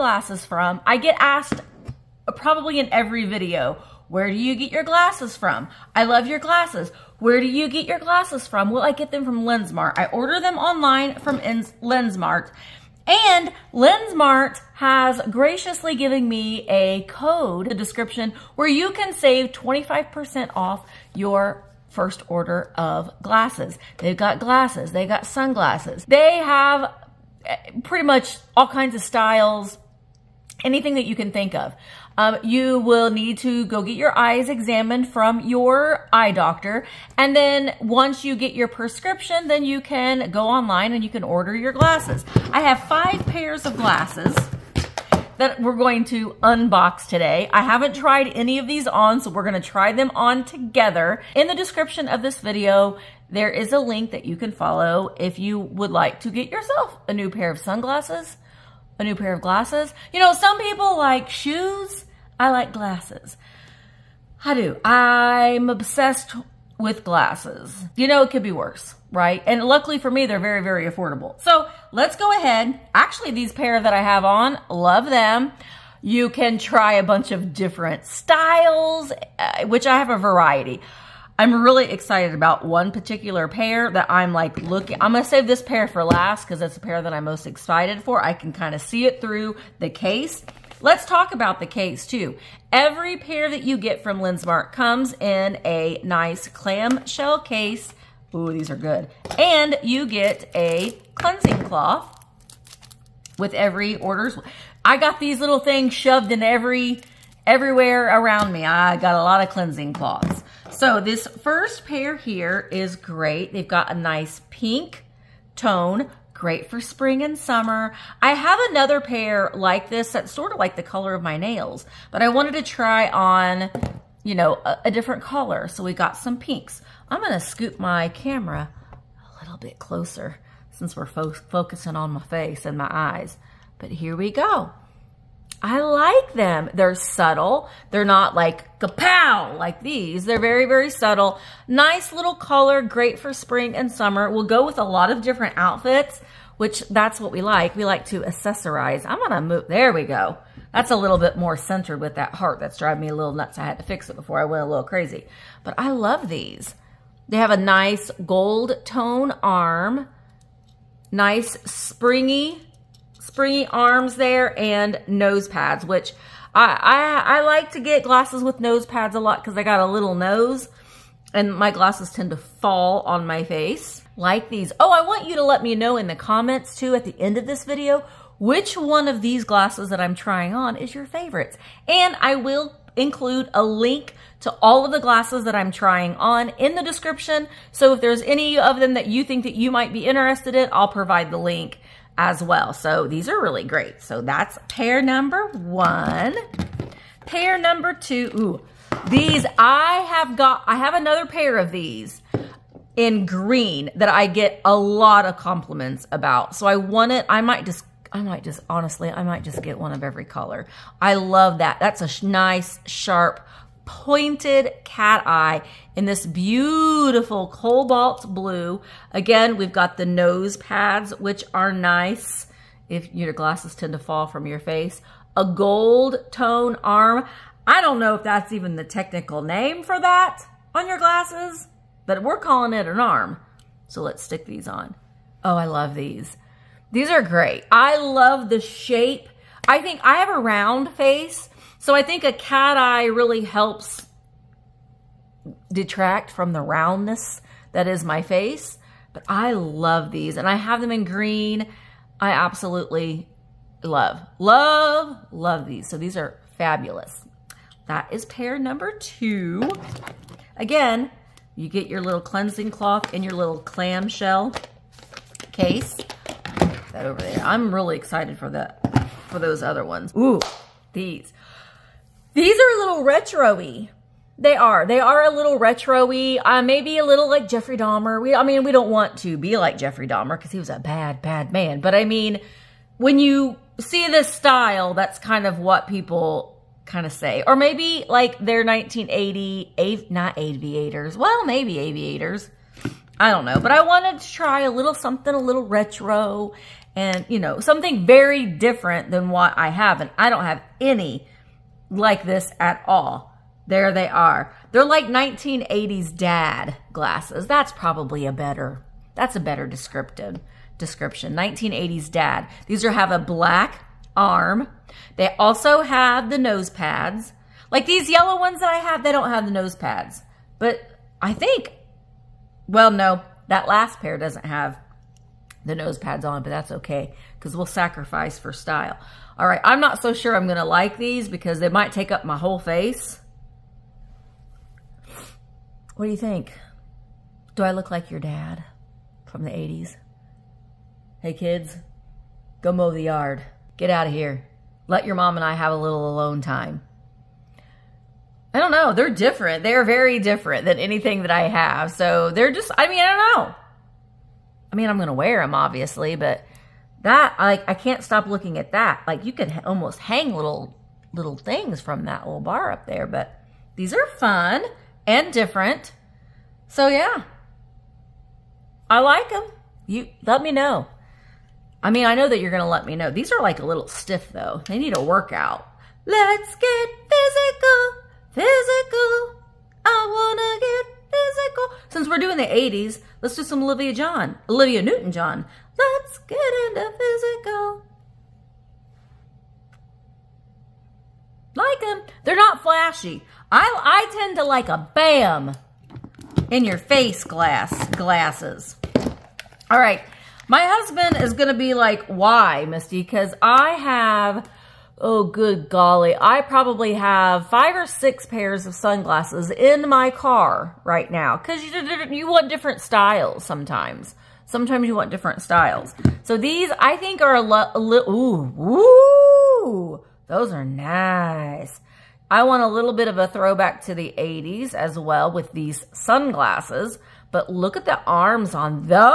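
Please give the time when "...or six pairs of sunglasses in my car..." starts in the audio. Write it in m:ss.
6:47.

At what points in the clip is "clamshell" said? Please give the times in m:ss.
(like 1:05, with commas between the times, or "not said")
1:36, 4:23.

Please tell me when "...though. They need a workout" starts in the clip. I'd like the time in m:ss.
6:14.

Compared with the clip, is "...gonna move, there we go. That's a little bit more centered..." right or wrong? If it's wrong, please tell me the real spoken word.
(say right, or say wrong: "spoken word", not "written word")
right.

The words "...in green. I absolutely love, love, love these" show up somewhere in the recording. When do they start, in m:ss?
4:10.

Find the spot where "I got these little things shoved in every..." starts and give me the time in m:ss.
1:44.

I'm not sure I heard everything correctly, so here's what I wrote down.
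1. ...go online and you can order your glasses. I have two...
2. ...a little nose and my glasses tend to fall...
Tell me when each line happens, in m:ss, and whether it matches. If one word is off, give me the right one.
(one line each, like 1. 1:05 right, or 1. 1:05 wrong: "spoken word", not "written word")
1. 0:40 wrong: "five", not "two"
2. 2:49 right.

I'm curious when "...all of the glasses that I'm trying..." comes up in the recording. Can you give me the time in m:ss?
3:04.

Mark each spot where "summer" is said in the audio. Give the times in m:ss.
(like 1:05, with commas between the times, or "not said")
1:57, 2:23.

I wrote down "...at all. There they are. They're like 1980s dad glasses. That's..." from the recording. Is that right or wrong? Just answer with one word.
right.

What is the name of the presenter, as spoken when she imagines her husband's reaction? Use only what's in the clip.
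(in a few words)
Misty.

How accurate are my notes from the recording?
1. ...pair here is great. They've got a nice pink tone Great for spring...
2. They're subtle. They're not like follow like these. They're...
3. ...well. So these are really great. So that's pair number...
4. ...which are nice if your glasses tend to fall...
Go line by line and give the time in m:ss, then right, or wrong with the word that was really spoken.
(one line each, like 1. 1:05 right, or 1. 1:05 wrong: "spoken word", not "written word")
1. 1:51 right
2. 2:16 wrong: "kapow", not "follow"
3. 3:12 right
4. 3:41 right.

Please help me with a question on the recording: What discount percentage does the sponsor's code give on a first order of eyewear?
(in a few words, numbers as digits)
25%.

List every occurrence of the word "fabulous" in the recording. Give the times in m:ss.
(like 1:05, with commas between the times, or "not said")
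4:16.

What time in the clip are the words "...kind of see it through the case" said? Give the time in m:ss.
1:28.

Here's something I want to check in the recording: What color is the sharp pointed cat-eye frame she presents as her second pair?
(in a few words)
cobalt blue.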